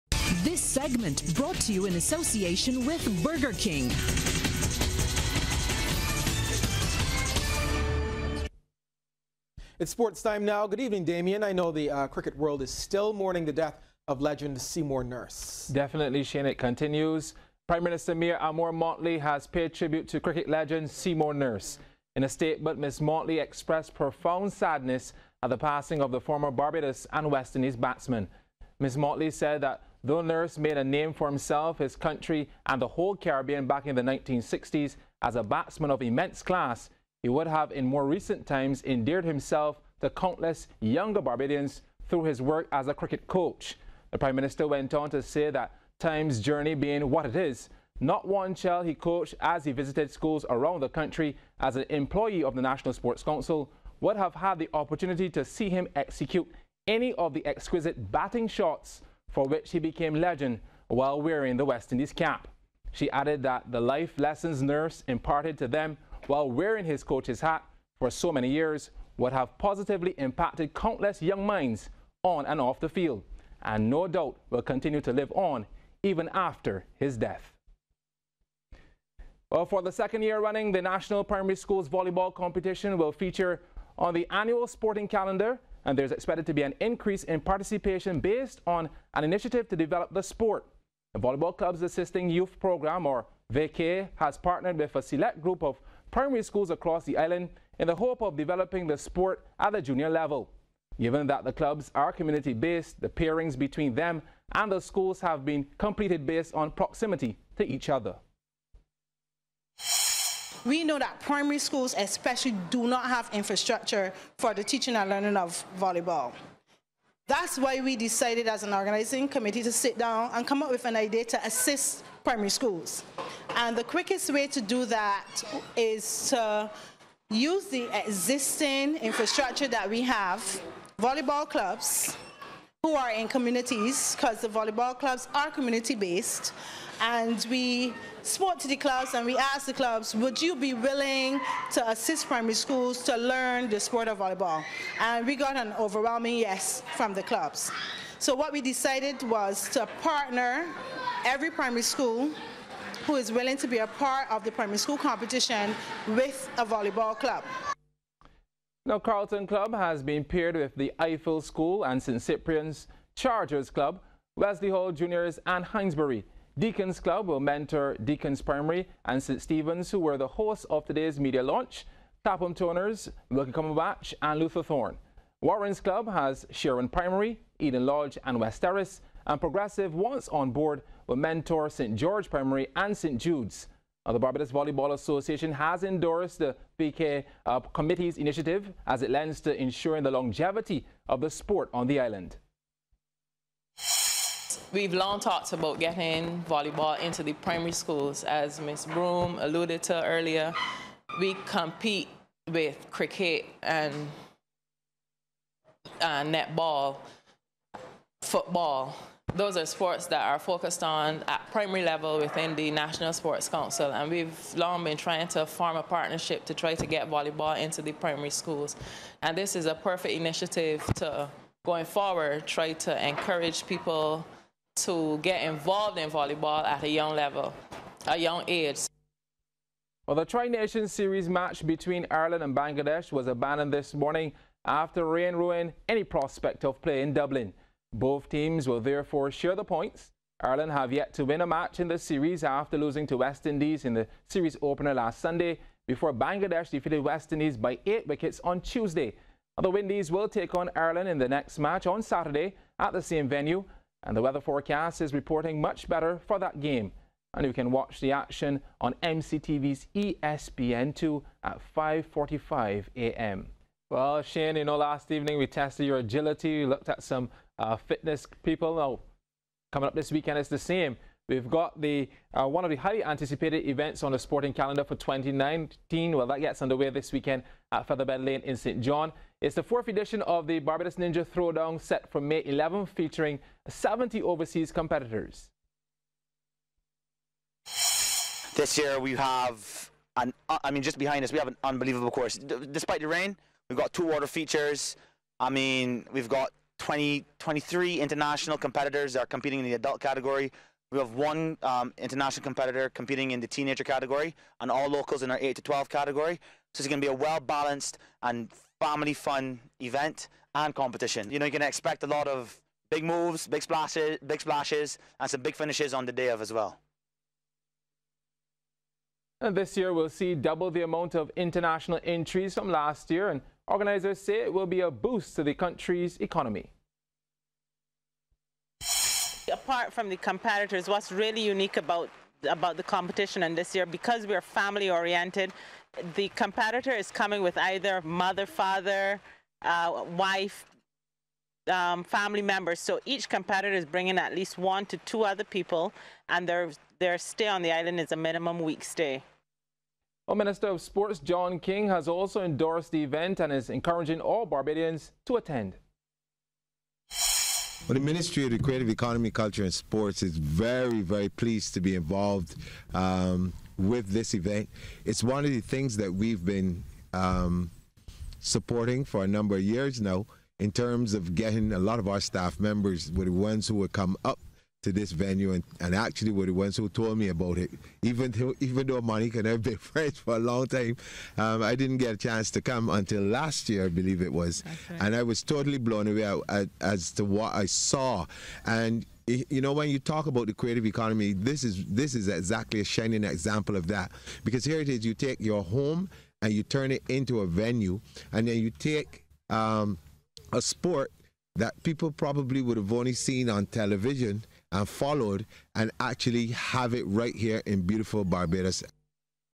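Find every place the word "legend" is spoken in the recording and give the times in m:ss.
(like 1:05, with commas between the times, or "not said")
0:14, 0:20, 1:00.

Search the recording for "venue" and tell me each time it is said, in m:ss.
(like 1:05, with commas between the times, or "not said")
4:13, 6:15, 6:37.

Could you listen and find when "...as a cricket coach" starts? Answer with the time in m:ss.
0:42.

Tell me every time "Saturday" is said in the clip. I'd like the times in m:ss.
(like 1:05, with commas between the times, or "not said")
4:12.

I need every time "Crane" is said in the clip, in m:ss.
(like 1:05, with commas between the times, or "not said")
not said.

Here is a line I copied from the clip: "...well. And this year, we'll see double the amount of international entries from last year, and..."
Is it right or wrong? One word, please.
right.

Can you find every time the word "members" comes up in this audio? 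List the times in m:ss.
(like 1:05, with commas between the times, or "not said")
5:42, 6:12.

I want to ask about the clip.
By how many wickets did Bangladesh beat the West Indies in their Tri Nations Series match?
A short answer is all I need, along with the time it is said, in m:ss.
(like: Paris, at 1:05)
8, at 4:07.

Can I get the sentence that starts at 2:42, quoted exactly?
Cyprian's Chargers Club, Wesley Hall Juniors and Hindsbury.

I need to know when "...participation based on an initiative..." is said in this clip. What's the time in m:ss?
1:27.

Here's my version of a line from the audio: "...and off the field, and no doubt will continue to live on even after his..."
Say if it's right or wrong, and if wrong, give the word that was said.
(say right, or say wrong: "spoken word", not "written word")
right.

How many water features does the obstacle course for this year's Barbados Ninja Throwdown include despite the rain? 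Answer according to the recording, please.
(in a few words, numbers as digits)
2.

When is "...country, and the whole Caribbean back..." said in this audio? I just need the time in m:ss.
0:31.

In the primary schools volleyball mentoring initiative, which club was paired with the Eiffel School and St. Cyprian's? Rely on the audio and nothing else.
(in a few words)
Carlton Club.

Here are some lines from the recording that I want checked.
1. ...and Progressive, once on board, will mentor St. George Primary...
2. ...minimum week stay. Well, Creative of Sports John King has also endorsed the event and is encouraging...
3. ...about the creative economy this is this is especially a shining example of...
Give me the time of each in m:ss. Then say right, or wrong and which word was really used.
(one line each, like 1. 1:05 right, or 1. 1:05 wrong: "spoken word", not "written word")
1. 2:59 right
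2. 5:48 wrong: "Minister", not "Creative"
3. 6:30 wrong: "exactly", not "especially".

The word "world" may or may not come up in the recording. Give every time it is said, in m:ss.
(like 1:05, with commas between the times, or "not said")
0:12.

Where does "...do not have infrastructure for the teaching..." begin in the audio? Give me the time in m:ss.
1:52.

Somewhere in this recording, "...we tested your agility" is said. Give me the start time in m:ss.
4:25.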